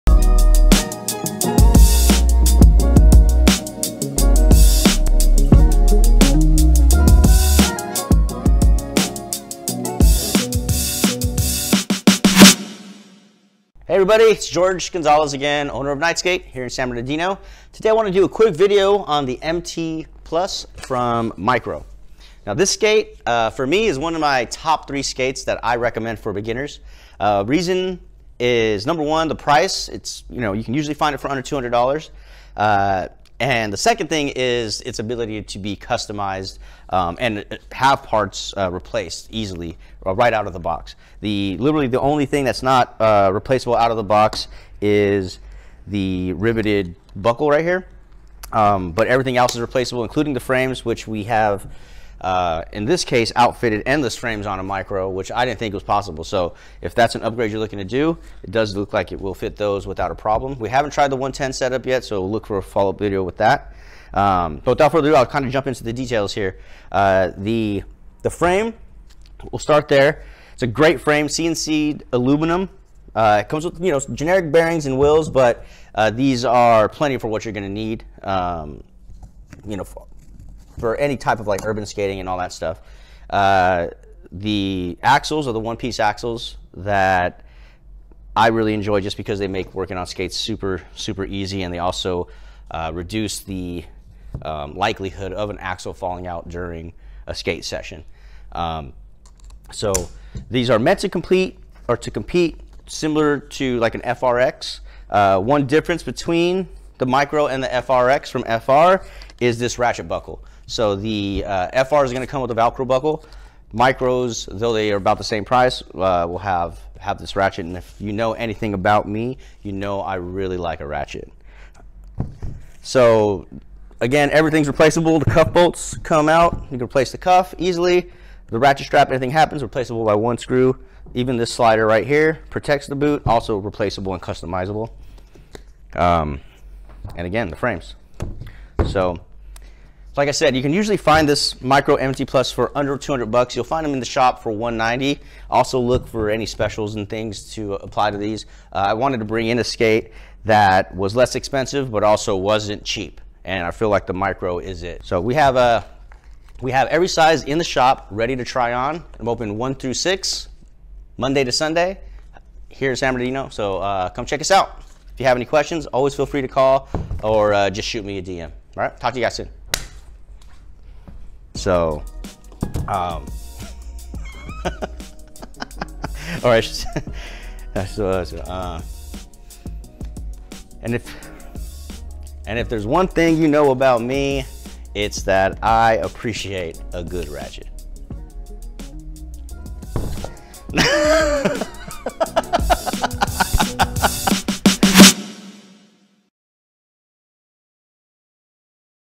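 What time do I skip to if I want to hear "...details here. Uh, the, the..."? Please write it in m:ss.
1:05.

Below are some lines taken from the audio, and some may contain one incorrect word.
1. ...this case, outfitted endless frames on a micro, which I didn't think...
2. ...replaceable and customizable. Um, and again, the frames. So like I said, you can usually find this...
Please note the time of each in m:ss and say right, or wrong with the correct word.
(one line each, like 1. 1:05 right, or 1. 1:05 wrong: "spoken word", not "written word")
1. 0:52 right
2. 2:13 right.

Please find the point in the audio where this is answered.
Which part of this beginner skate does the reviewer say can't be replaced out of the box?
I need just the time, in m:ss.
0:46.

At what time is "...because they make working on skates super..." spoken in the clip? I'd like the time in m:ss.
1:29.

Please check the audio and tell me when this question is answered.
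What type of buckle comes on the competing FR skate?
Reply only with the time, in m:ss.
1:52.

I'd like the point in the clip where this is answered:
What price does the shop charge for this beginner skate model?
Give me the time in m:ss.
2:24.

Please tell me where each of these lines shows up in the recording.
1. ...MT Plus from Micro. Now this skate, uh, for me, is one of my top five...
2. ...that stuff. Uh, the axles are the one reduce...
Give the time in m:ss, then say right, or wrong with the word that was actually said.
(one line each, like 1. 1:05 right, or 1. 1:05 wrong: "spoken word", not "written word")
1. 0:19 wrong: "three", not "five"
2. 1:22 wrong: "piece", not "reduce".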